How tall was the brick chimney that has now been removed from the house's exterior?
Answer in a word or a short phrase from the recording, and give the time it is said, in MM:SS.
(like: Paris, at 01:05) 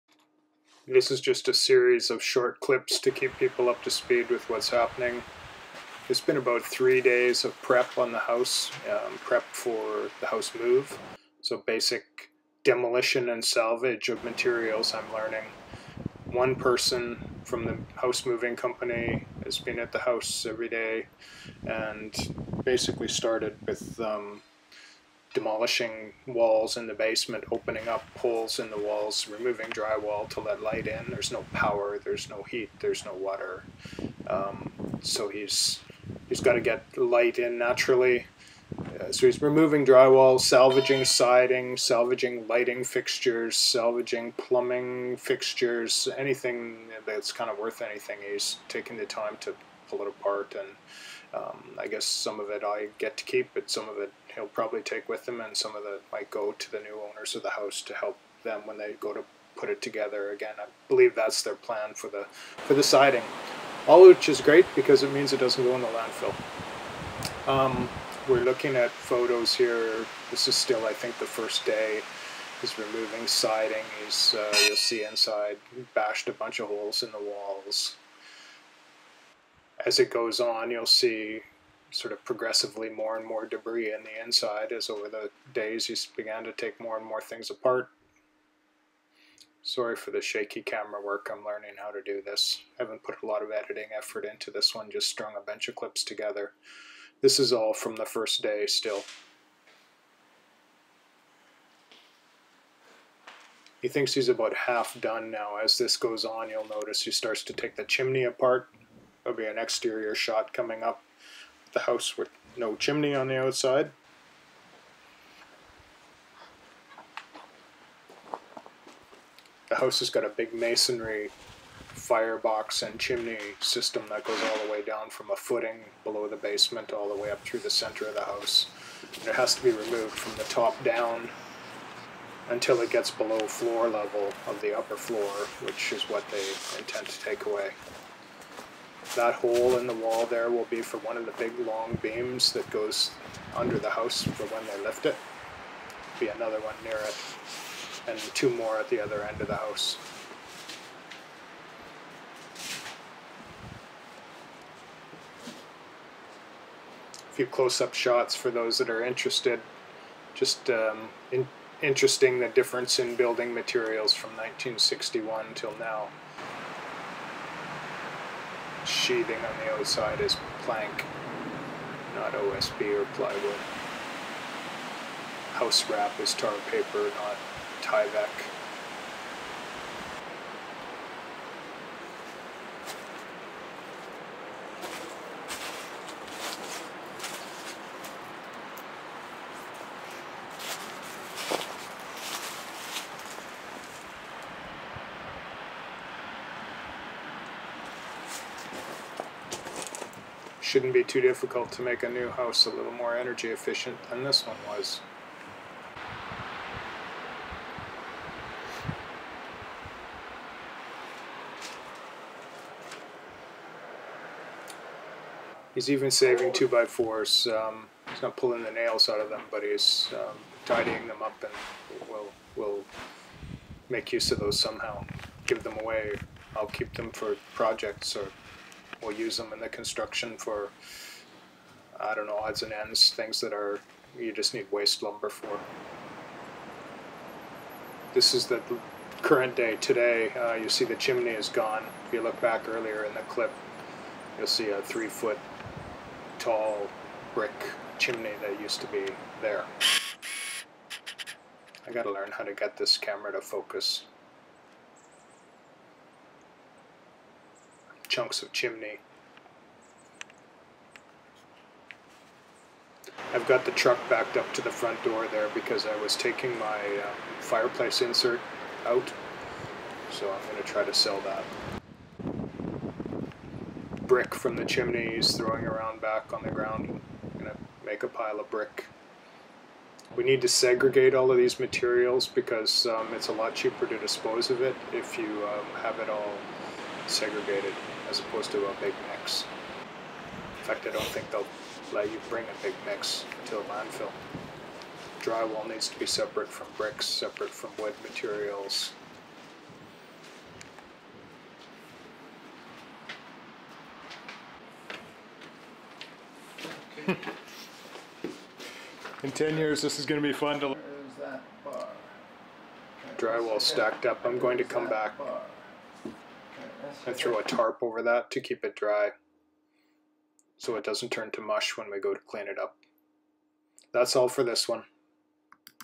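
3 feet, at 04:04.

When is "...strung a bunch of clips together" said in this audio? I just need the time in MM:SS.
01:35.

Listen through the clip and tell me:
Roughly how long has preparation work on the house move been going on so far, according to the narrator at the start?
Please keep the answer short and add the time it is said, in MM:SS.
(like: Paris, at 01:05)
3 days, at 00:06.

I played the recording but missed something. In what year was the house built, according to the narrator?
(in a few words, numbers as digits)
1961.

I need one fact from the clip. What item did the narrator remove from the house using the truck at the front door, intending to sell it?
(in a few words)
Fireplace insert.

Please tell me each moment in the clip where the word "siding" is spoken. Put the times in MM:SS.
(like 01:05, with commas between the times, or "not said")
00:41, 01:02, 01:13.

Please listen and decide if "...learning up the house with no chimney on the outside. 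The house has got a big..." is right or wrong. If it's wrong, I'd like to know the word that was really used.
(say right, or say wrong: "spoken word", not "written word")
wrong: "coming", not "learning".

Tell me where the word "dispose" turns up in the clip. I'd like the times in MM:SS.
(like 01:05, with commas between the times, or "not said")
04:43.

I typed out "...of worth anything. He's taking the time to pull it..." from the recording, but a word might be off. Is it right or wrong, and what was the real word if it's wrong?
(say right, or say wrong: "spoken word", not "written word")
right.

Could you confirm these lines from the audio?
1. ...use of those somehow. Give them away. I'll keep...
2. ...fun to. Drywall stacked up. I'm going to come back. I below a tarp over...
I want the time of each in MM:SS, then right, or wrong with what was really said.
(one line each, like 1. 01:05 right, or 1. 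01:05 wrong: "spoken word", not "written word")
1. 03:44 right
2. 05:10 wrong: "throw", not "below".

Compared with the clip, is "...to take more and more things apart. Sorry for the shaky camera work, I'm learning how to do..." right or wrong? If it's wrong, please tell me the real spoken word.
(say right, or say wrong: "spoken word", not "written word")
right.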